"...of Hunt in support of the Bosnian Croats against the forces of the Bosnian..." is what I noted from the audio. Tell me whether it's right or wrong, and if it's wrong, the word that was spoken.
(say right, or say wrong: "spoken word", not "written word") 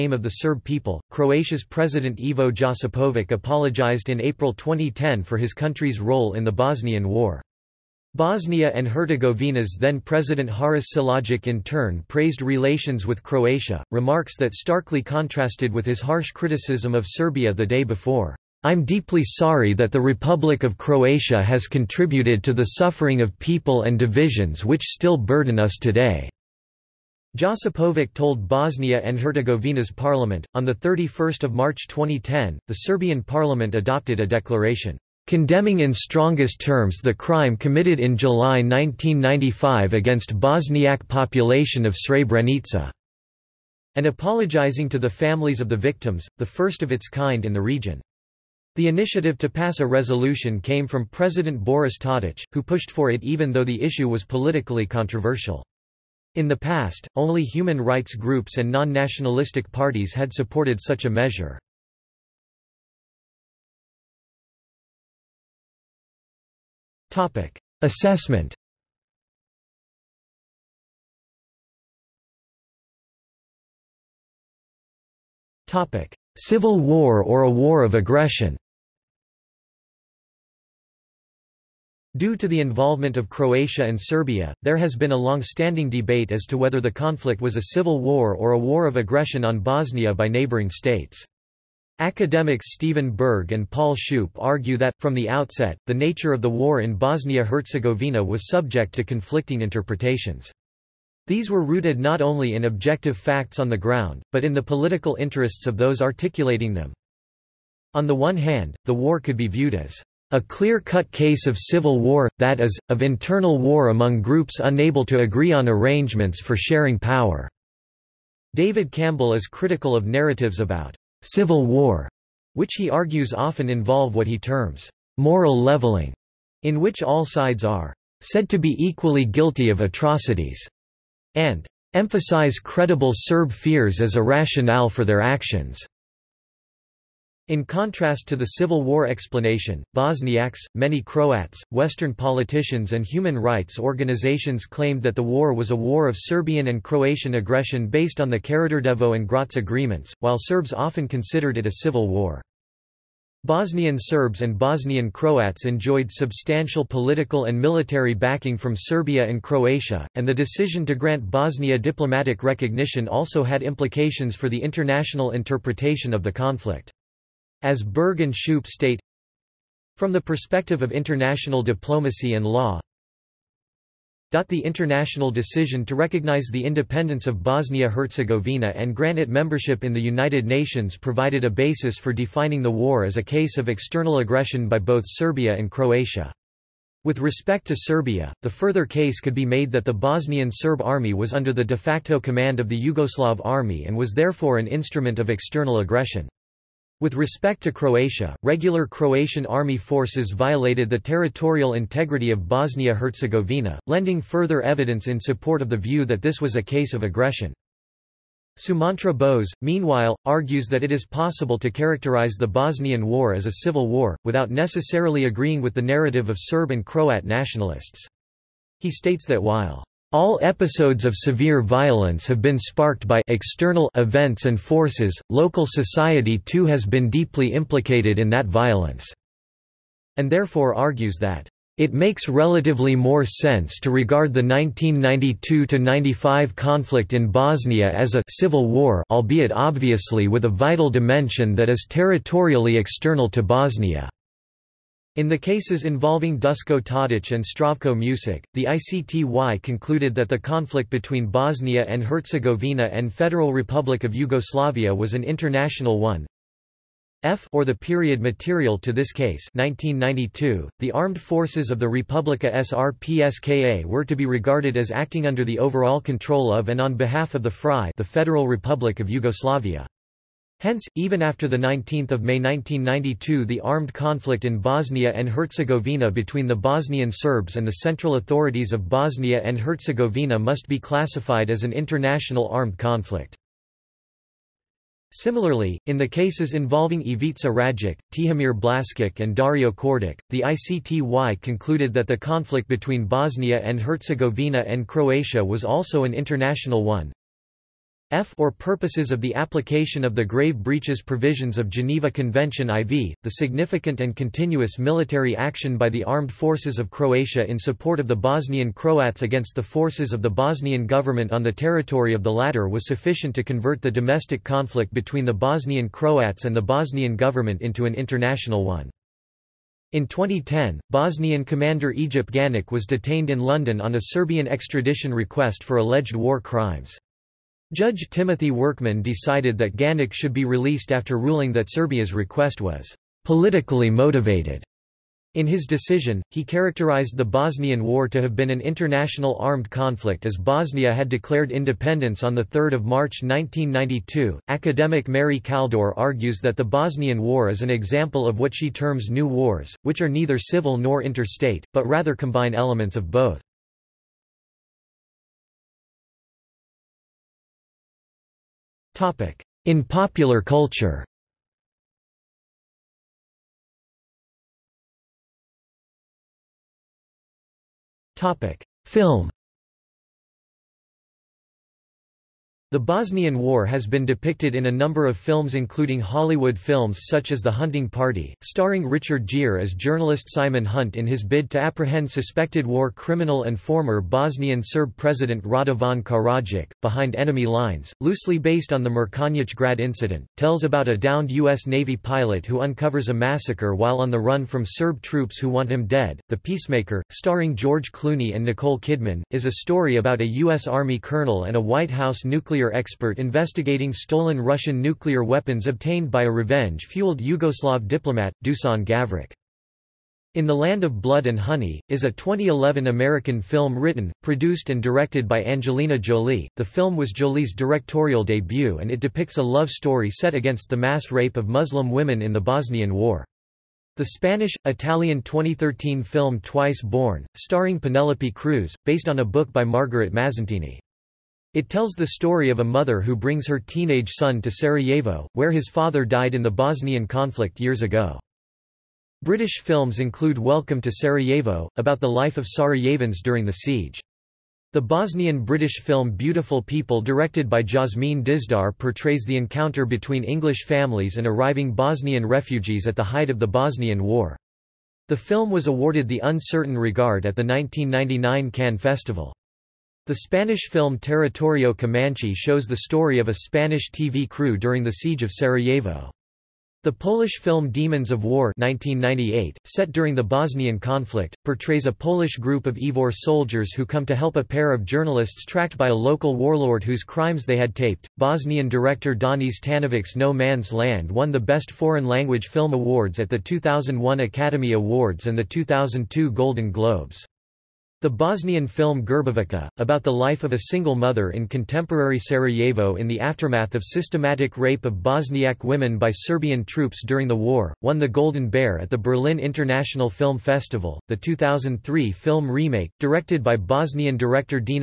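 wrong: "Croatia", not "Hunt".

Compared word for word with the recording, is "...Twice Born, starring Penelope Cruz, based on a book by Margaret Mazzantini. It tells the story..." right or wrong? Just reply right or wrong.
right.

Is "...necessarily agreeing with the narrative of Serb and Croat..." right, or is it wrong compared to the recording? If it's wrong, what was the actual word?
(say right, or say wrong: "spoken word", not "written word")
right.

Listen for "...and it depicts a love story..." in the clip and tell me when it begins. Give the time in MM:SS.
06:58.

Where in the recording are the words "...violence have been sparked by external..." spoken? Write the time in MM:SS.
03:41.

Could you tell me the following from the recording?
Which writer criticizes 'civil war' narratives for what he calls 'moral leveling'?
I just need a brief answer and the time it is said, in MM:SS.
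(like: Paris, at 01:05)
David Campbell, at 01:58.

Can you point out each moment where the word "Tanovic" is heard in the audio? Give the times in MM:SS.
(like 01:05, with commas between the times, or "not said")
07:59.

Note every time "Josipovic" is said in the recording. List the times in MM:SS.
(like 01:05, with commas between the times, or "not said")
00:02, 00:27.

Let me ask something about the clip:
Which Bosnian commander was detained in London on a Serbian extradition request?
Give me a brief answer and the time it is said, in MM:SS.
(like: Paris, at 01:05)
Ejup Ganic, at 05:21.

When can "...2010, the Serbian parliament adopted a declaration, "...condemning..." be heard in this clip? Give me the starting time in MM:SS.
00:31.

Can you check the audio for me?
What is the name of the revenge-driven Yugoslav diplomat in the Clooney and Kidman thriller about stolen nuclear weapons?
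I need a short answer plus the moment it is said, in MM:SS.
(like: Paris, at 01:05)
Dusan Gavric, at 06:48.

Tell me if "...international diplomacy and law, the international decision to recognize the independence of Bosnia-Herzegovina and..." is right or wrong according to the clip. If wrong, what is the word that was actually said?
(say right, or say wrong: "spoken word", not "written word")
right.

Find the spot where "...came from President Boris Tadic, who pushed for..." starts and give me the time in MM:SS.
00:50.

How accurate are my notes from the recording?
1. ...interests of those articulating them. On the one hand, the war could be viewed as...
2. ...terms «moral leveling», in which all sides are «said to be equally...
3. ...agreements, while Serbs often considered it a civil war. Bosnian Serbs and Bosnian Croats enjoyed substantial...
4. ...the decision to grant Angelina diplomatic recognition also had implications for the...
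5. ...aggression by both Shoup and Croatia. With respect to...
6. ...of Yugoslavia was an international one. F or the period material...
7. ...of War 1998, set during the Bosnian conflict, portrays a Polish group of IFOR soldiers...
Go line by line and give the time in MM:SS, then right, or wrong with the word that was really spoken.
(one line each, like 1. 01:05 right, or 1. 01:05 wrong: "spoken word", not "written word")
1. 01:45 right
2. 02:04 right
3. 02:29 right
4. 02:40 wrong: "Bosnia", not "Angelina"
5. 03:04 wrong: "Serbia", not "Shoup"
6. 04:14 right
7. 07:48 right.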